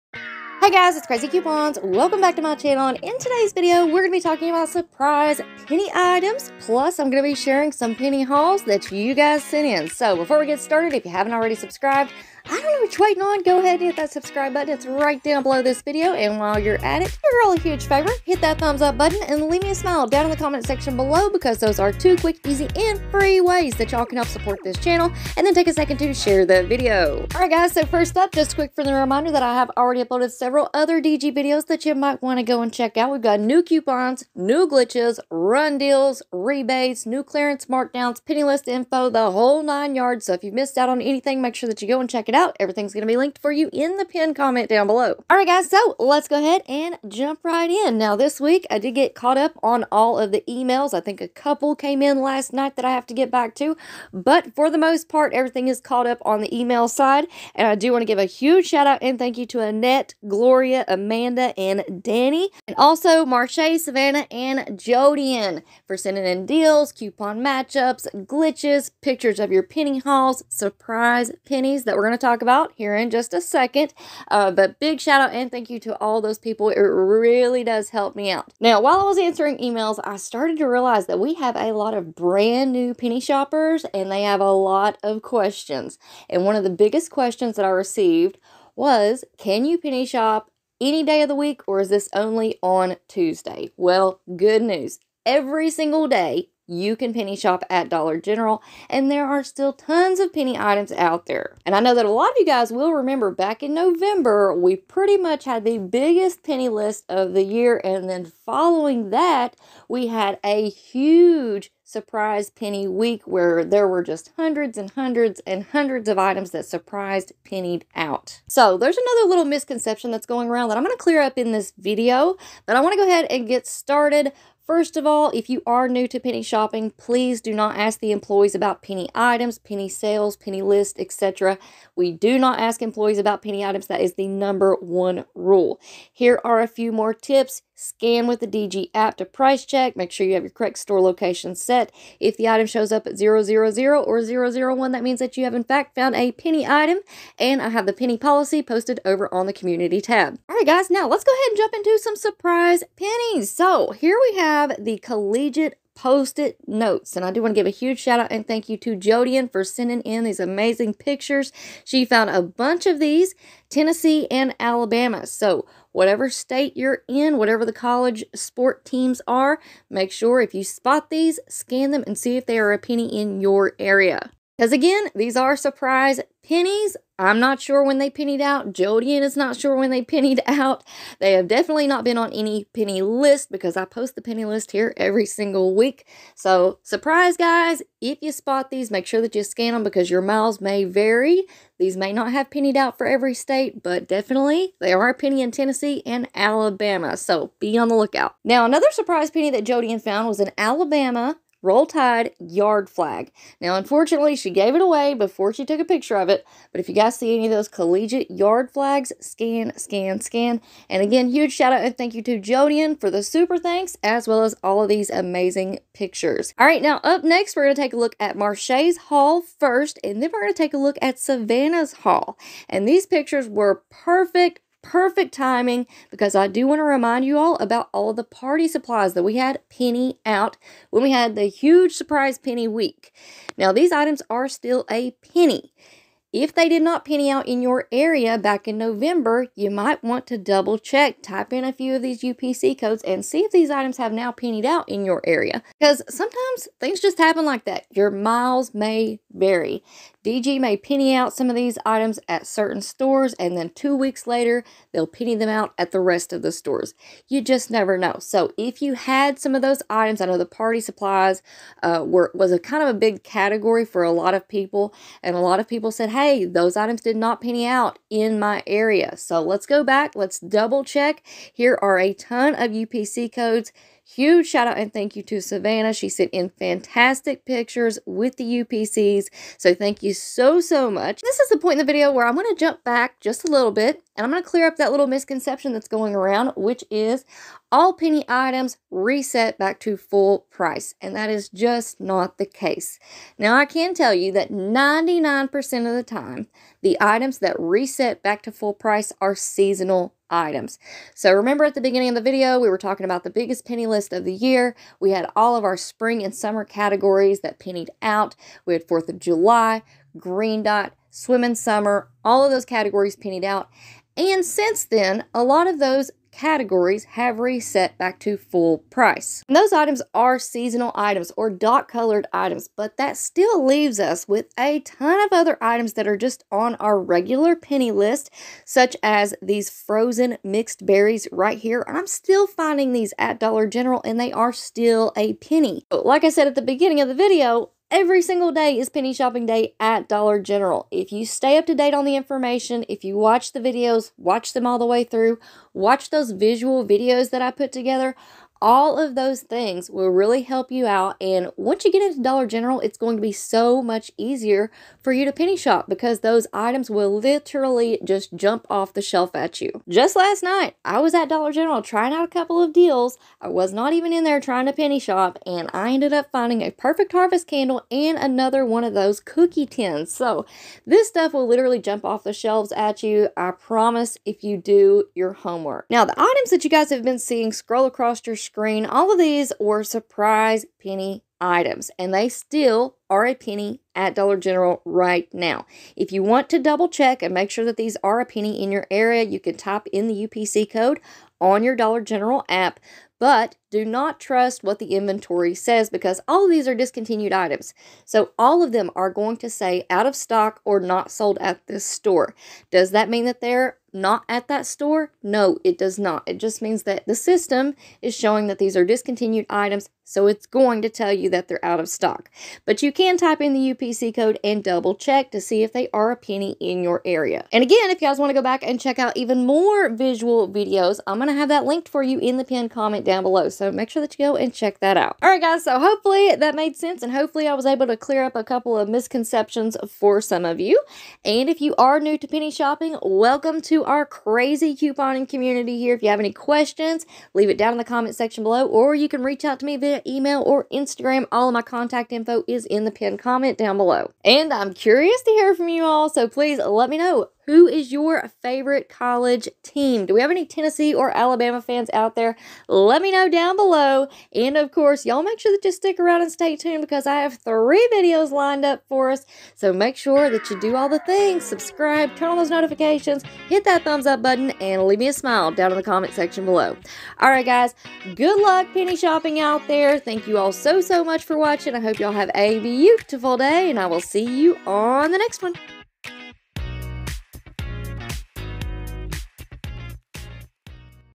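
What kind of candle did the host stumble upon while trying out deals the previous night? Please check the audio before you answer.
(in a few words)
Perfect Harvest candle.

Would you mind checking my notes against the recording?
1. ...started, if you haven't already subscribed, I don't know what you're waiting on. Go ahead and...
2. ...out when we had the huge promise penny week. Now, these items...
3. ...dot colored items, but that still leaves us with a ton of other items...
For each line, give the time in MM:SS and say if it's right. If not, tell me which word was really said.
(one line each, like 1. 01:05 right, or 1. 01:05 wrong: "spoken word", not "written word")
1. 00:10 right
2. 03:50 wrong: "surprise", not "promise"
3. 05:21 right.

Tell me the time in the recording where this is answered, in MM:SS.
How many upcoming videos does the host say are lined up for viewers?
07:37.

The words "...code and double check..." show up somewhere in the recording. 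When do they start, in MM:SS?
06:54.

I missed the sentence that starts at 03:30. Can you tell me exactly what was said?
And again, huge shout out and thank you to Jodian for the super thanks, as well as all of these amazing pictures.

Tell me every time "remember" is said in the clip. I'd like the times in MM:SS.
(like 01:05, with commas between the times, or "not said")
01:42, 05:01.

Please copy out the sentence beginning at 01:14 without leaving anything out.
Uh, but big shout out and thank you to all those people.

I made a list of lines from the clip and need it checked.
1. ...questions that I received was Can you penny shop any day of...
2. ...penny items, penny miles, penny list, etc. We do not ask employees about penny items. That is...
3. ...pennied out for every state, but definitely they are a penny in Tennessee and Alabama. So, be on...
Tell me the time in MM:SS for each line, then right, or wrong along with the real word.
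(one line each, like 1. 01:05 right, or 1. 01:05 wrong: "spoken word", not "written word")
1. 01:27 right
2. 02:08 wrong: "sales", not "miles"
3. 03:12 right.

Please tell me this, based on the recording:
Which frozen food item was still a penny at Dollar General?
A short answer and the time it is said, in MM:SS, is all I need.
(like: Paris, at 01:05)
Frozen mixed berries, at 05:29.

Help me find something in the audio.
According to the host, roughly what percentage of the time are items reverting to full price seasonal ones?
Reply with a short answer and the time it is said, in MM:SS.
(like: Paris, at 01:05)
99%, at 04:54.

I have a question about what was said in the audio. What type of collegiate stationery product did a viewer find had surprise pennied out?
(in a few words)
Post-it notes.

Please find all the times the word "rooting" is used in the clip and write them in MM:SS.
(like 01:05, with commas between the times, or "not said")
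not said.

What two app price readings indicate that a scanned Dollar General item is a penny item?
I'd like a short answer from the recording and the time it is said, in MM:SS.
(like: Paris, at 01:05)
000 or 001, at 02:23.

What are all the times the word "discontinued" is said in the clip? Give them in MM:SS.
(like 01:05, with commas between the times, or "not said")
06:36, 06:48.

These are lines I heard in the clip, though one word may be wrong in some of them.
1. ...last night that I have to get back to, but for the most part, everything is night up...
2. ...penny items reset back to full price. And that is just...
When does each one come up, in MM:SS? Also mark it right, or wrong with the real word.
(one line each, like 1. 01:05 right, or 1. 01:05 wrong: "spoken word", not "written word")
1. 00:52 wrong: "caught", not "night"
2. 04:47 right.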